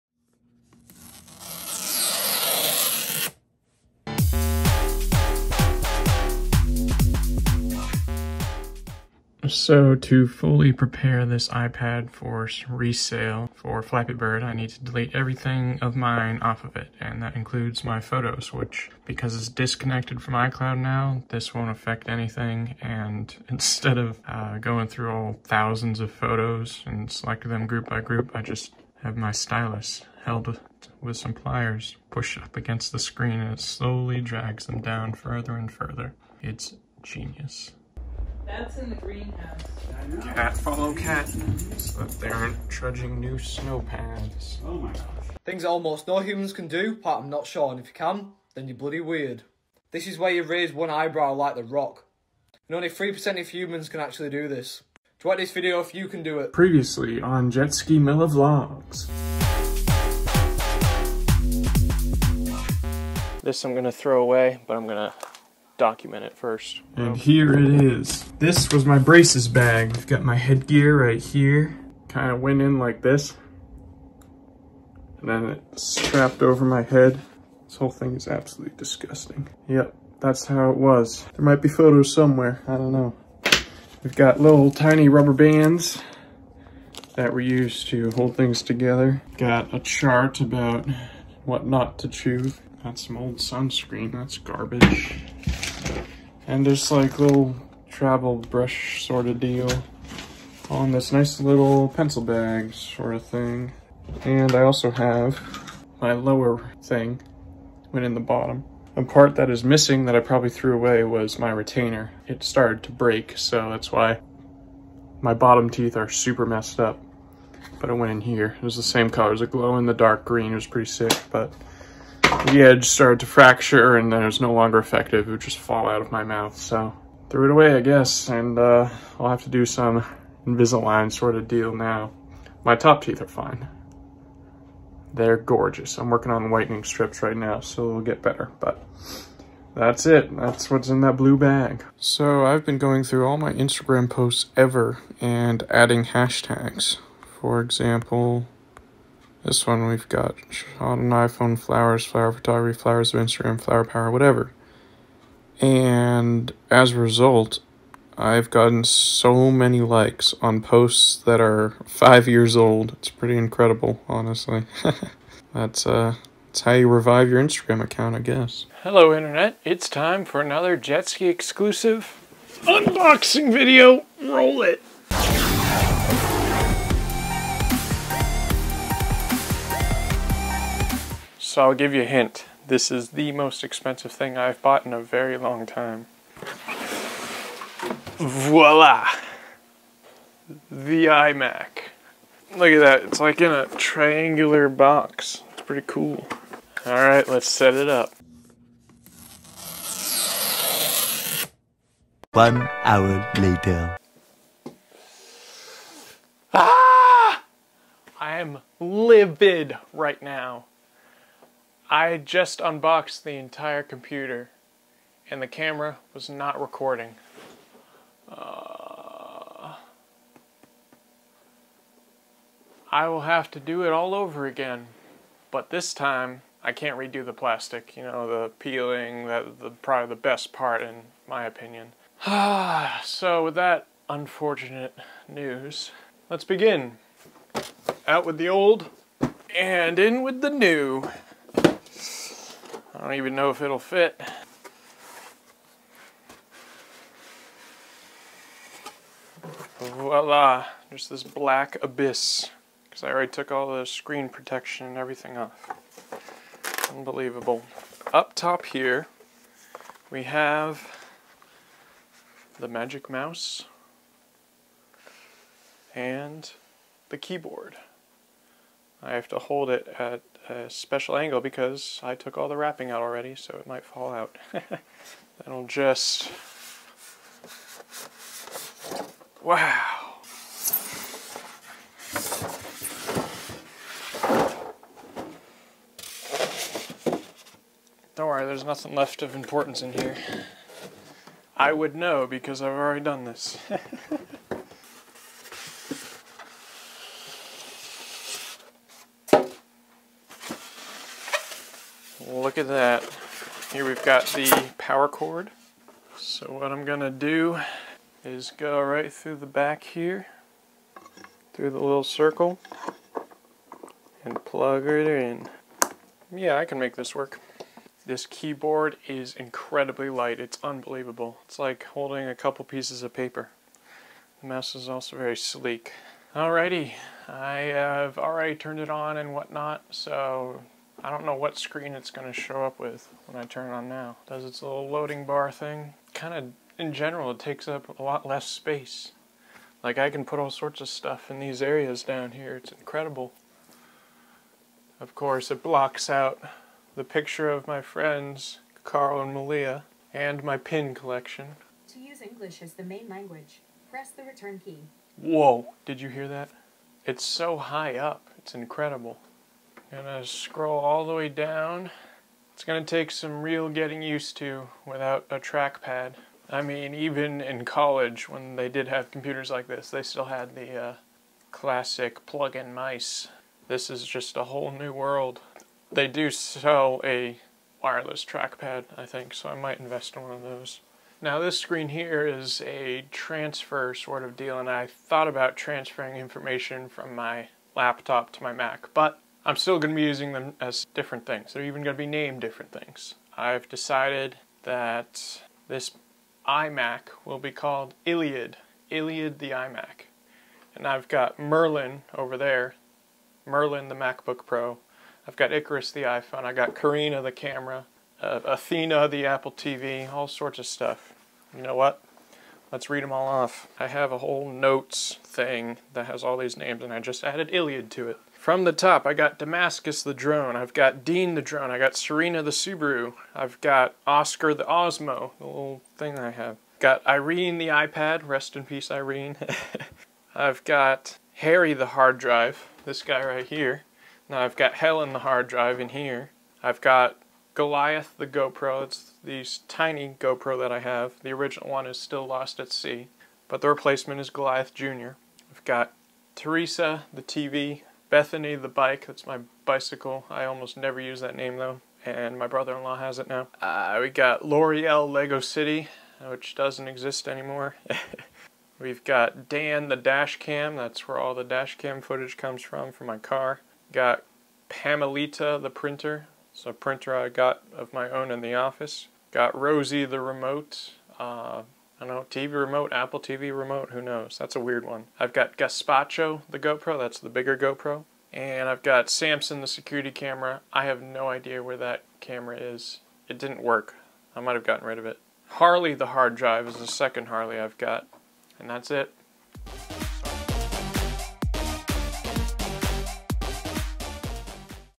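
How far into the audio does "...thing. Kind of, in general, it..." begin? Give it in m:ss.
5:35.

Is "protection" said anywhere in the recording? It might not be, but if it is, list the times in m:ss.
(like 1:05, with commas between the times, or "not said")
4:14.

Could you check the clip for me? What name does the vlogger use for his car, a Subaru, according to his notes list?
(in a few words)
Serena.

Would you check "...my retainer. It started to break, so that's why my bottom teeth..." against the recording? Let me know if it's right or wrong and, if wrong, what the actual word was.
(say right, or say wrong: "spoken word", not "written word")
right.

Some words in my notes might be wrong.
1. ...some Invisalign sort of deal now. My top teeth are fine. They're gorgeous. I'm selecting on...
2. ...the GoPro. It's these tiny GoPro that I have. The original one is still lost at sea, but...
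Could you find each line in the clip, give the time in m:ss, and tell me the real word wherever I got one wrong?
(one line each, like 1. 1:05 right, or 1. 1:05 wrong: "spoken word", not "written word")
1. 2:09 wrong: "working", not "selecting"
2. 7:18 right.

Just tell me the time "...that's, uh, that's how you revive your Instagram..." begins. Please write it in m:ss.
2:45.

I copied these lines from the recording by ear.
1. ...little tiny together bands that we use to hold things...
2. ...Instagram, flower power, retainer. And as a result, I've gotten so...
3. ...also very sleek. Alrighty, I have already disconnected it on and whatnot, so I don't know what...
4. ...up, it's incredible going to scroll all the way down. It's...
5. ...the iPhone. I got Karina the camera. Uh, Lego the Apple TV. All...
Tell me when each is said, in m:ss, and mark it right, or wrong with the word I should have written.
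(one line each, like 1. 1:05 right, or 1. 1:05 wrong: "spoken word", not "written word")
1. 1:24 wrong: "rubber", not "together"
2. 2:33 wrong: "whatever", not "retainer"
3. 5:24 wrong: "turned", not "disconnected"
4. 5:57 right
5. 6:45 wrong: "Athena", not "Lego".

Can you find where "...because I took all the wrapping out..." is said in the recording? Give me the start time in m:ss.
4:31.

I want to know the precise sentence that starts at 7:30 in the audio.
I almost never use that name though, and my brother-in-law has it now.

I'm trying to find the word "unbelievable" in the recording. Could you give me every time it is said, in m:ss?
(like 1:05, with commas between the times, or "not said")
4:16, 5:20.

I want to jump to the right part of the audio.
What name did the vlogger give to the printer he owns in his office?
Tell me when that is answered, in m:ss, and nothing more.
7:44.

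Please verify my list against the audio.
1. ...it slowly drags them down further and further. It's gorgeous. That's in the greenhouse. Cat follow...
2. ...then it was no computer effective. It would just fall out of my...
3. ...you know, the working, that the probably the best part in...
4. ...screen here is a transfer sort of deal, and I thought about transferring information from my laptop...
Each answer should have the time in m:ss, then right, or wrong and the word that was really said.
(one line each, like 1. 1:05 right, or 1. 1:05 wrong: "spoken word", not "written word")
1. 0:33 wrong: "genius", not "gorgeous"
2. 2:04 wrong: "longer", not "computer"
3. 3:47 wrong: "peeling", not "working"
4. 6:21 right.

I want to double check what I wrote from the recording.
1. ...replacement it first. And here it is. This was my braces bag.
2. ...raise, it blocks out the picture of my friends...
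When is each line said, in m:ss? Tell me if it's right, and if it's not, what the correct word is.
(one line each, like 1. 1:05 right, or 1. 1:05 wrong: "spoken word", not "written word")
1. 1:05 wrong: "document", not "replacement"
2. 5:45 wrong: "course", not "raise".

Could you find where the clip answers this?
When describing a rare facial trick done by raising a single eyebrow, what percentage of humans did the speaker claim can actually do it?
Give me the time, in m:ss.
0:52.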